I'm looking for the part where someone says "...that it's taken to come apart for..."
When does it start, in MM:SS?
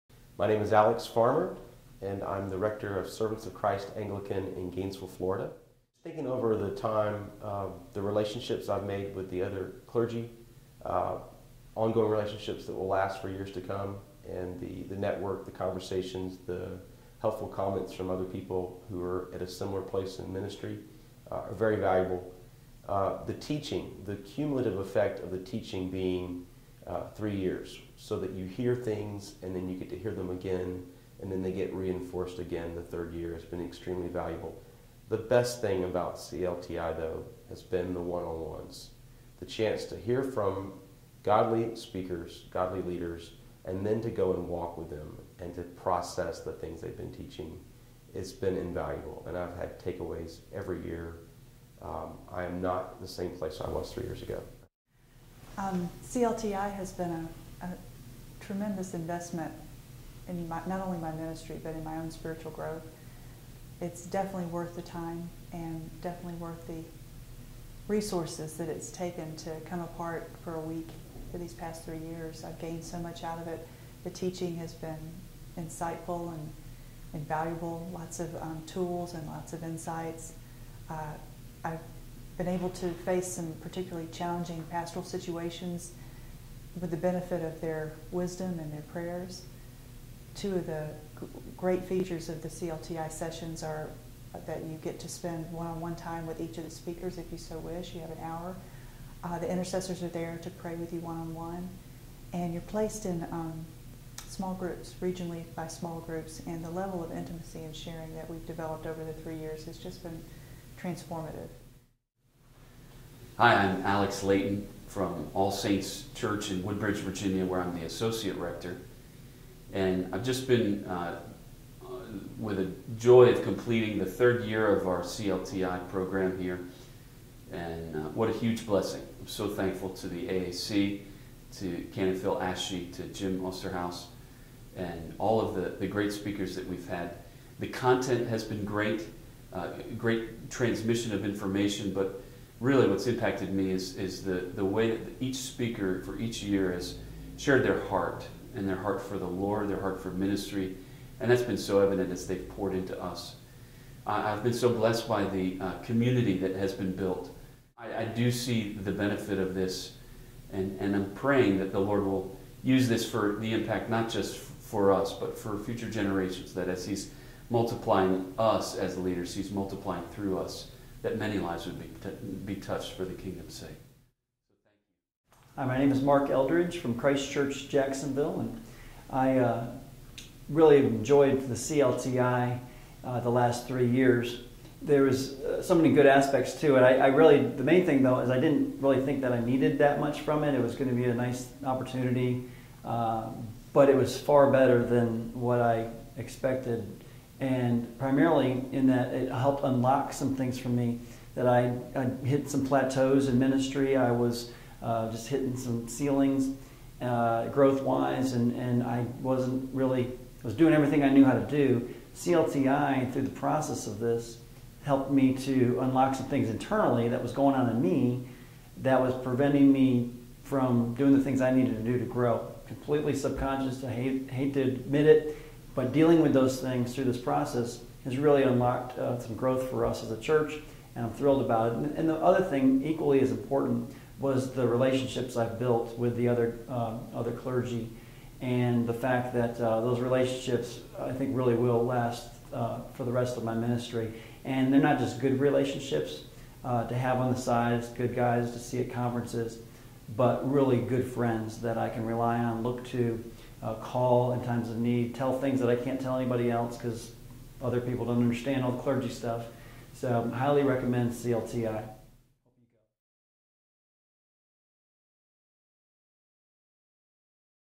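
01:08.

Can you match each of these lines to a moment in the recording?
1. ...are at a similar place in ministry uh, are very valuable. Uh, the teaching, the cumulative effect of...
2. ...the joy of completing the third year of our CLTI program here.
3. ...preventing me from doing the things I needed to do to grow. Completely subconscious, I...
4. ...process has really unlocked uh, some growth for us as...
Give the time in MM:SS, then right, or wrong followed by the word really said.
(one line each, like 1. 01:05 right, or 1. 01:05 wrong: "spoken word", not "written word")
1. 00:19 right
2. 02:02 right
3. 03:39 right
4. 03:47 right.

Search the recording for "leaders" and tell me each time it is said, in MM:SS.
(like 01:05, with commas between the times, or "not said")
00:42, 02:48.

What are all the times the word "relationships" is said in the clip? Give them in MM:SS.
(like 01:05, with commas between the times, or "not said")
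00:08, 00:12, 03:54, 03:59, 04:05.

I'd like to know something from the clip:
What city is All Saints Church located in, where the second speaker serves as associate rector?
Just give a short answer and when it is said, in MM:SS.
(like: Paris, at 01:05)
Woodbridge, Virginia, at 01:56.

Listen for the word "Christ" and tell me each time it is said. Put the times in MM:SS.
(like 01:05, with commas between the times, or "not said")
00:03, 02:56.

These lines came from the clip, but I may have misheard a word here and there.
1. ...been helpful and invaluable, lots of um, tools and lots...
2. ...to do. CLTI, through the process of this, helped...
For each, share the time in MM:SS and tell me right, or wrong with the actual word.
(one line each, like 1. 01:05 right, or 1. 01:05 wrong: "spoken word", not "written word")
1. 01:14 wrong: "insightful", not "helpful"
2. 03:31 right.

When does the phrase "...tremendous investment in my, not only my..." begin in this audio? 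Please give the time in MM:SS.
00:58.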